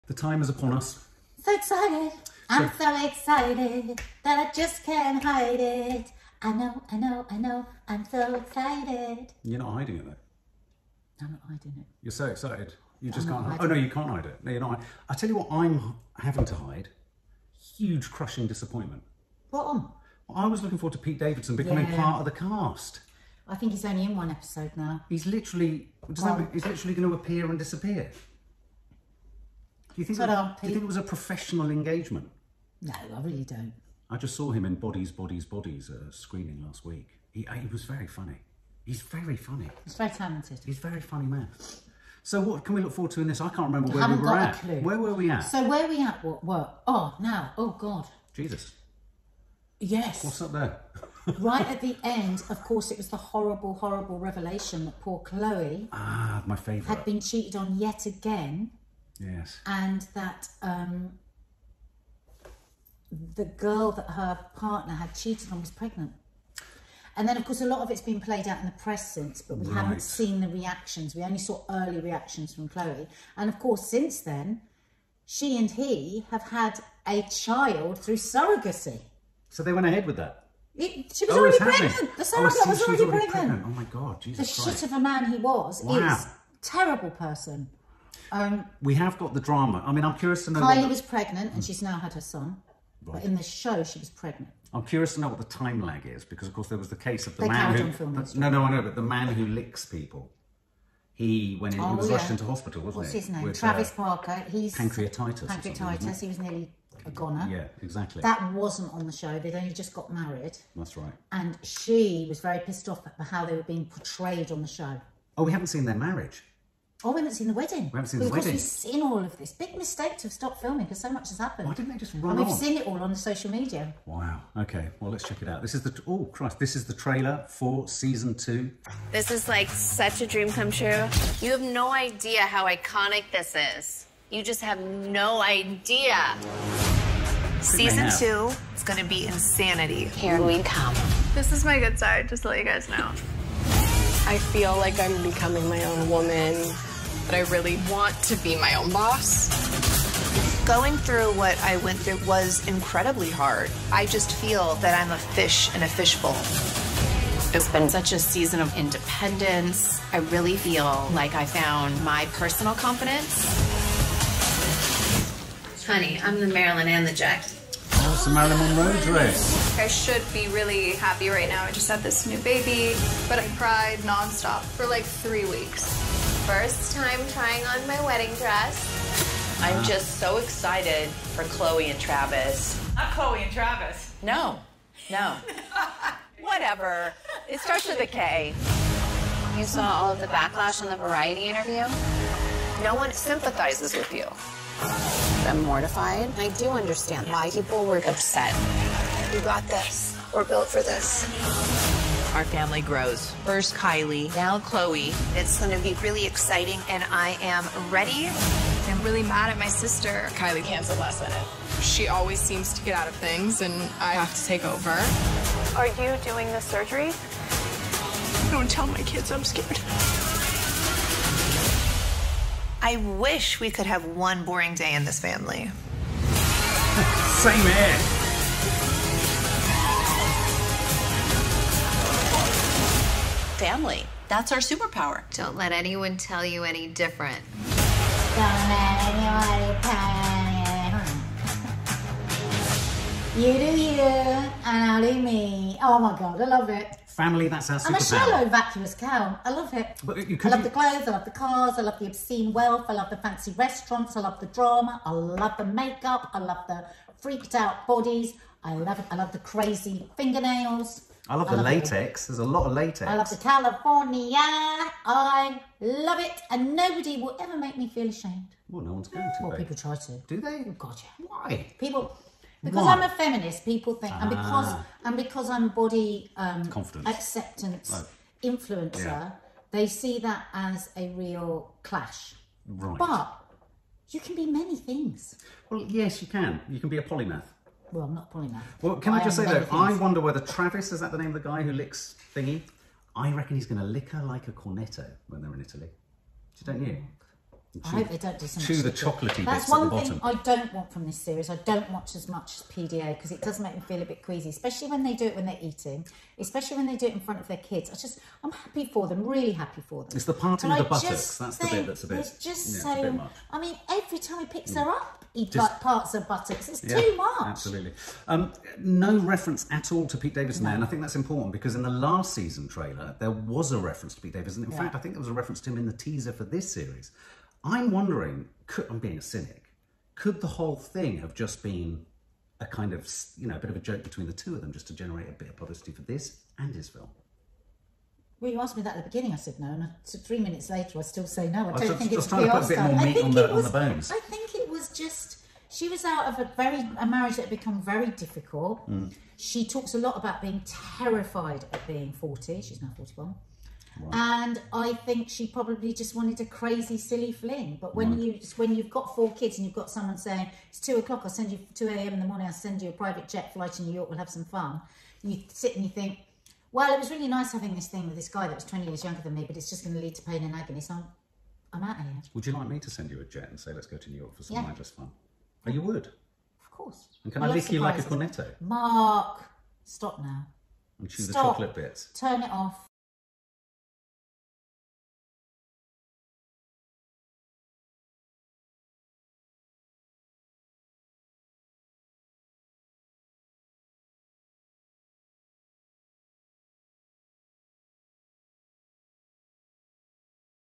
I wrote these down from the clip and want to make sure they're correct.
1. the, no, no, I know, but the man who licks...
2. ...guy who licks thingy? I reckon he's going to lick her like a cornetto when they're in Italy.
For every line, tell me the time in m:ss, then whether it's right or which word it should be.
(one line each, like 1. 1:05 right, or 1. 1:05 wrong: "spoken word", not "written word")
1. 1:38 right
2. 4:51 right.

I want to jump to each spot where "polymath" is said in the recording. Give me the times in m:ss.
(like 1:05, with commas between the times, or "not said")
4:47.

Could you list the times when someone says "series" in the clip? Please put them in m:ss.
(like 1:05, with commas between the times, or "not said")
5:01, 5:26.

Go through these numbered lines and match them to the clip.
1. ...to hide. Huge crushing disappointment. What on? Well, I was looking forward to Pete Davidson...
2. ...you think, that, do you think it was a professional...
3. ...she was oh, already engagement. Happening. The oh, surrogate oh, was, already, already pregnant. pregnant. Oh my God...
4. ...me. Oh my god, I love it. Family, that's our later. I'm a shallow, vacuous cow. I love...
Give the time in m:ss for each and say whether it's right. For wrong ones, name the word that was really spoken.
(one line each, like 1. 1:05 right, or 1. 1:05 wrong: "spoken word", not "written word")
1. 0:16 right
2. 0:30 right
3. 1:21 wrong: "pregnant", not "engagement"
4. 4:05 wrong: "superpower", not "later".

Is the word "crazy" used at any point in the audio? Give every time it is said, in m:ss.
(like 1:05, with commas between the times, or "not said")
4:19, 5:56.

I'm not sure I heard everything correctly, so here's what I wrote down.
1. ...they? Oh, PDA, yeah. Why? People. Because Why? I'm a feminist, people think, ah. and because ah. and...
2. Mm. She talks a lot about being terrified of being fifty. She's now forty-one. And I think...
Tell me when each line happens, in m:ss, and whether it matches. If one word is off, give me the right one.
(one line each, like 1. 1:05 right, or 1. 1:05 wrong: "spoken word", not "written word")
1. 4:30 wrong: "God", not "PDA"
2. 5:48 wrong: "forty", not "fifty".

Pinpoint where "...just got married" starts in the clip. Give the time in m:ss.
1:49.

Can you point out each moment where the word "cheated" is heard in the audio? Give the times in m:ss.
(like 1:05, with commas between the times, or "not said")
0:57, 1:05.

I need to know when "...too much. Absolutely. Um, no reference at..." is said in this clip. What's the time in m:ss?
5:16.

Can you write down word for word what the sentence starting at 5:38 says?
Well, you asked me that at the beginning.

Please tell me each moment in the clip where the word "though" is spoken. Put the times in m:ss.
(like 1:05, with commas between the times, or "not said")
0:10, 4:49.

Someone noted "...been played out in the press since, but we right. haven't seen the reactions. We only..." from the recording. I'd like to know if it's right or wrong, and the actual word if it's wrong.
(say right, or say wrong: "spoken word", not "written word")
right.